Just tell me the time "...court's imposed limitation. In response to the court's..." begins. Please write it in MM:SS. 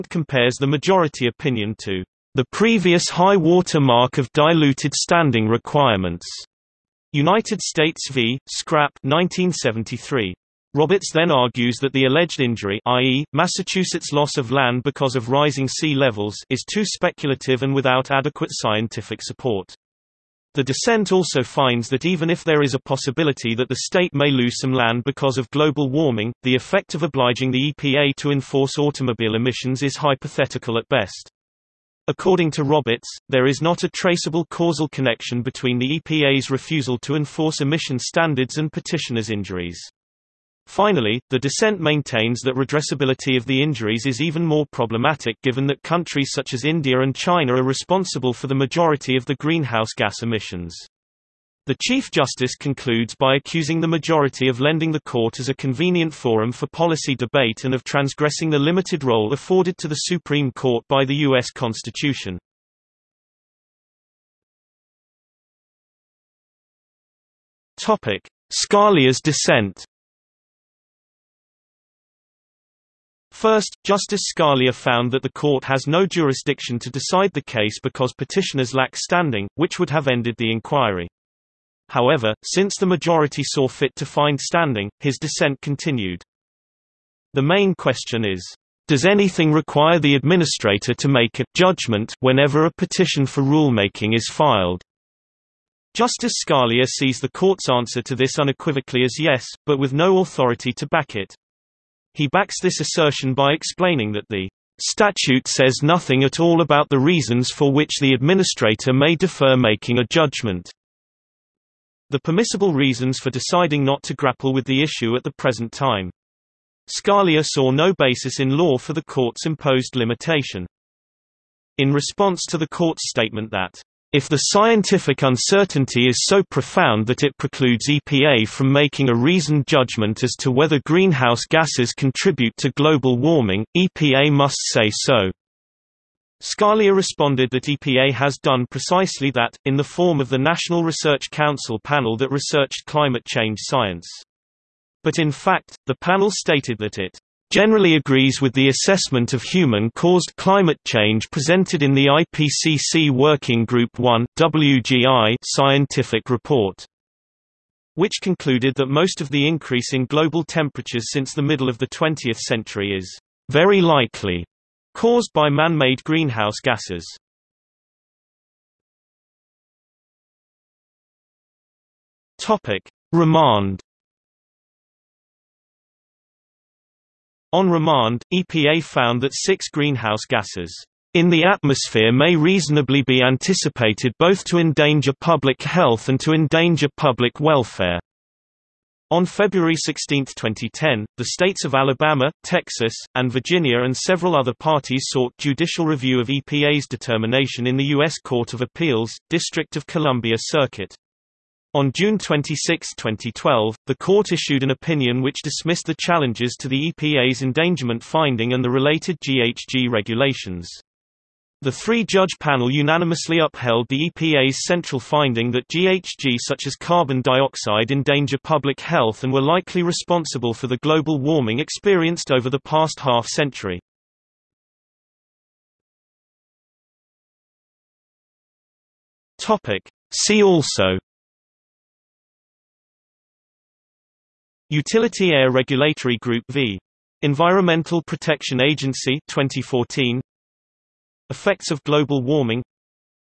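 01:59.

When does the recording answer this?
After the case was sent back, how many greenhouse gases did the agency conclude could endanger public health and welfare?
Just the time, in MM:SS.
02:59.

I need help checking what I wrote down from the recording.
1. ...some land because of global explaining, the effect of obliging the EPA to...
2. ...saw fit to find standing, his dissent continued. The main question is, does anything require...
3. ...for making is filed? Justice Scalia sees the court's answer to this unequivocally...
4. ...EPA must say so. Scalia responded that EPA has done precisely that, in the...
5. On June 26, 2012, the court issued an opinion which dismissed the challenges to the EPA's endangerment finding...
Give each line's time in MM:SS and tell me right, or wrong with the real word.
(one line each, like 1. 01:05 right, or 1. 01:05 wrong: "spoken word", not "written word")
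1. 00:24 wrong: "warming", not "explaining"
2. 01:23 right
3. 01:33 wrong: "rulemaking", not "making"
4. 02:13 right
5. 03:21 right.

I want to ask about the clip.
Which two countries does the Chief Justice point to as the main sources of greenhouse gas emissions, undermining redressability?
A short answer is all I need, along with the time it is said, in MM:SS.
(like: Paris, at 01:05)
India and China, at 00:46.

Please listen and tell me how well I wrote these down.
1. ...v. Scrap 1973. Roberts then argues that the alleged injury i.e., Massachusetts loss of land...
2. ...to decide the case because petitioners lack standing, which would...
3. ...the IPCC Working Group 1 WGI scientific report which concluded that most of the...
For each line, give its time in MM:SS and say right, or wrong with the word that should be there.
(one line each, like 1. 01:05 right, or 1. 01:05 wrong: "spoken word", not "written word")
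1. 00:08 right
2. 01:16 right
3. 02:31 right.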